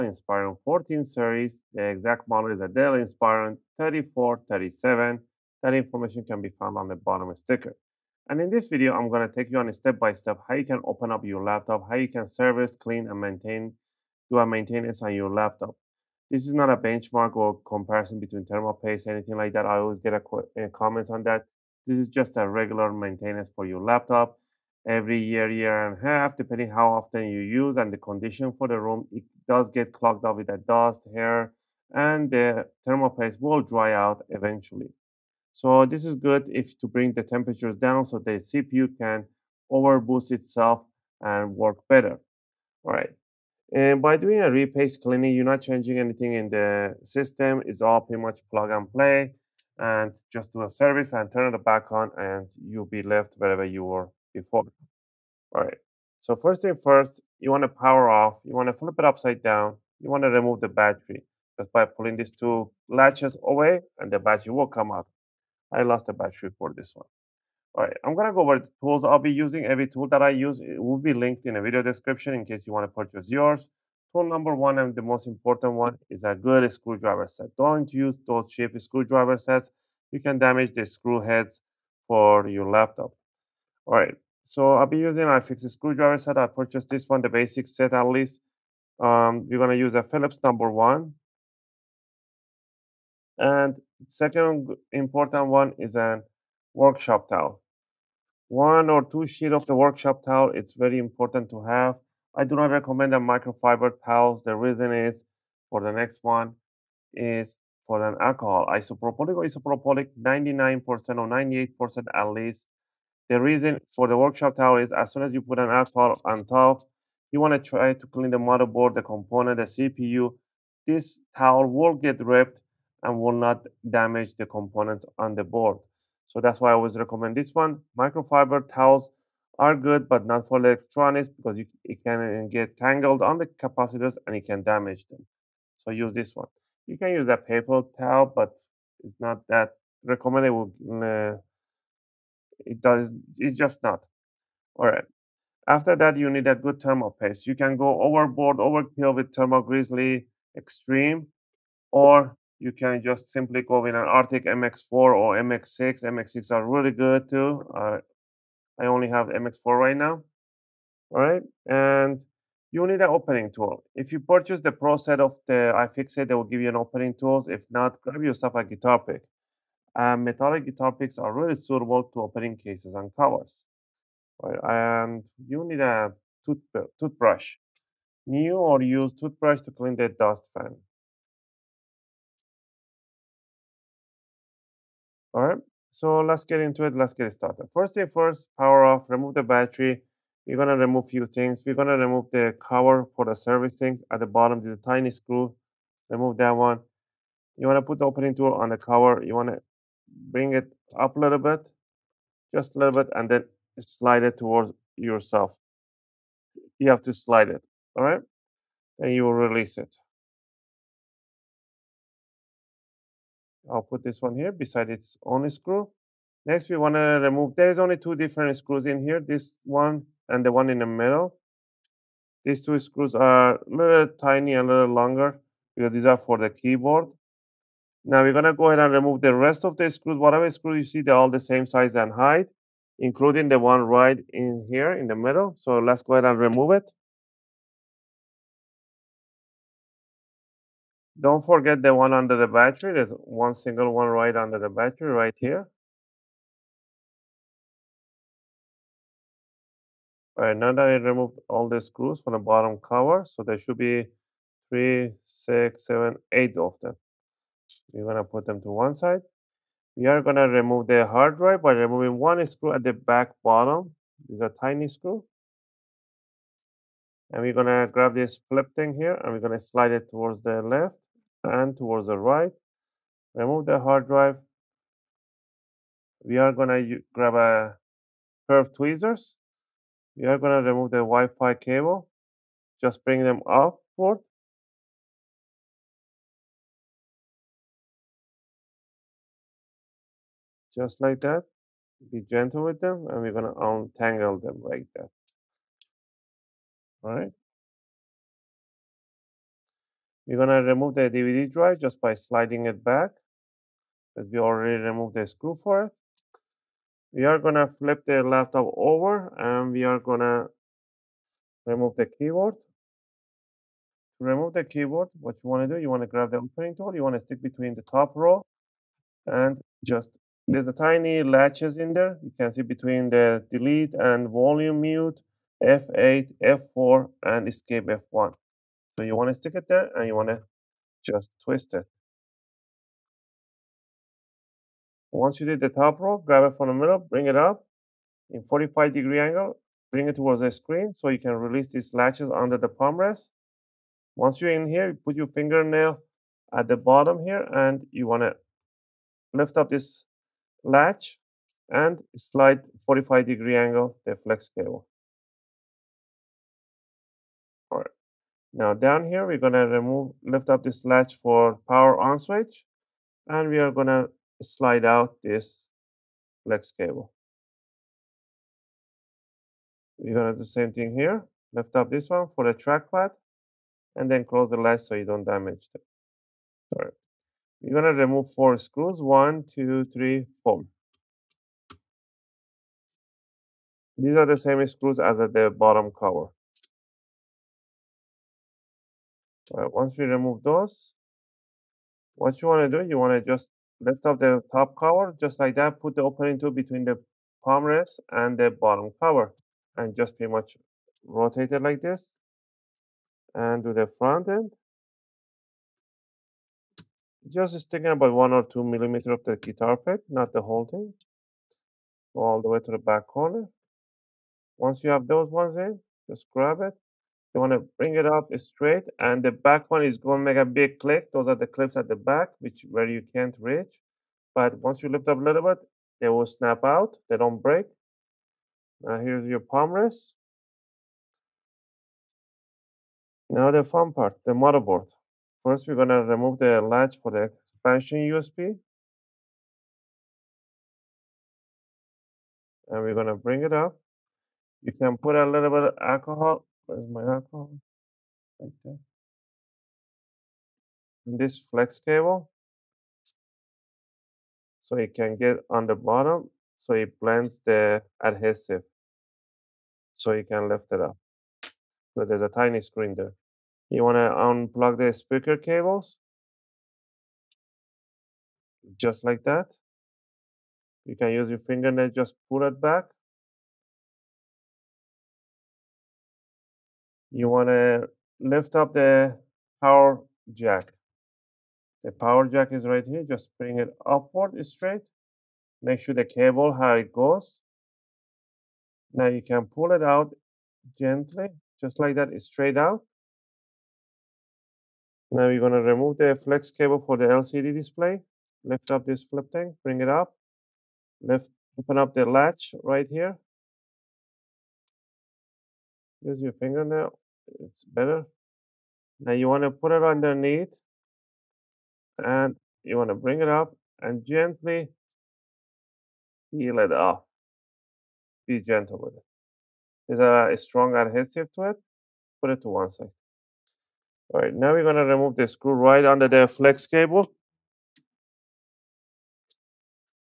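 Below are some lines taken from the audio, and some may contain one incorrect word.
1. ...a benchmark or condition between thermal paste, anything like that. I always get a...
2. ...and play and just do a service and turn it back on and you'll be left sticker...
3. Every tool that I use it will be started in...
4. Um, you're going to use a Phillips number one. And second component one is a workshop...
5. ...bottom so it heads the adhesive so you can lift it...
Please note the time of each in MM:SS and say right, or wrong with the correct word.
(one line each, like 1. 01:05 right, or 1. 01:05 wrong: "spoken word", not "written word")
1. 00:16 wrong: "comparison", not "condition"
2. 00:48 wrong: "wherever", not "sticker"
3. 01:09 wrong: "linked", not "started"
4. 01:29 wrong: "important", not "component"
5. 07:35 wrong: "blends", not "heads".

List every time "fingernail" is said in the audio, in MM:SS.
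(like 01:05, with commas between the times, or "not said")
05:45, 07:51, 08:26.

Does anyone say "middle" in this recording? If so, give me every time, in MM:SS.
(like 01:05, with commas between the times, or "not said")
03:40, 03:55, 05:36.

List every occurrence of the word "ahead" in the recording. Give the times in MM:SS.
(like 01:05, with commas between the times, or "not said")
03:48, 03:56.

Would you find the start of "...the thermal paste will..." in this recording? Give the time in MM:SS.
00:32.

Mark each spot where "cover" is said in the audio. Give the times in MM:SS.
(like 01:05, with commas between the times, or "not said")
02:53, 03:12, 03:18, 04:12, 06:25, 06:34, 06:39.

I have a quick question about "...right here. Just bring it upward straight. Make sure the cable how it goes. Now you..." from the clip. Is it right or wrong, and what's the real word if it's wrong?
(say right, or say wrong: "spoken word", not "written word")
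right.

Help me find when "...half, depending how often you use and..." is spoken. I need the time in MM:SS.
00:26.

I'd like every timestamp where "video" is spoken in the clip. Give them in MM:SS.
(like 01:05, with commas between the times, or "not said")
00:08, 01:11.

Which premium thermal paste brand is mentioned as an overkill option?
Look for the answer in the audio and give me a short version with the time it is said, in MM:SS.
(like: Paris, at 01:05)
Thermal Grizzly Extreme, at 02:29.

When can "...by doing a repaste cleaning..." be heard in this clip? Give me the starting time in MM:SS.
00:44.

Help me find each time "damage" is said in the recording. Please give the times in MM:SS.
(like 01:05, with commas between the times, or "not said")
01:20, 02:03, 02:14, 06:15.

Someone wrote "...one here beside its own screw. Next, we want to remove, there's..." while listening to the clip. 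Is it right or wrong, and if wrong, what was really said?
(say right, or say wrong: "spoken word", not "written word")
right.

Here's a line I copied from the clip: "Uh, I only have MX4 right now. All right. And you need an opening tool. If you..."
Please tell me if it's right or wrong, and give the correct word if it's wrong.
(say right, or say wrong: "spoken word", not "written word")
right.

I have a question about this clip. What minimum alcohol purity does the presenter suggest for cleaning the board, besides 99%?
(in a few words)
98%.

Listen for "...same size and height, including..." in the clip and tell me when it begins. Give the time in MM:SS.
03:51.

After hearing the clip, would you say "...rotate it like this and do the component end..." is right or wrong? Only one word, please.
wrong.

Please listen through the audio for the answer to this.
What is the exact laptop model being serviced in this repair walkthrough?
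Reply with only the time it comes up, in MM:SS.
00:02.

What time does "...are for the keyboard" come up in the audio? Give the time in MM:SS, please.
03:46.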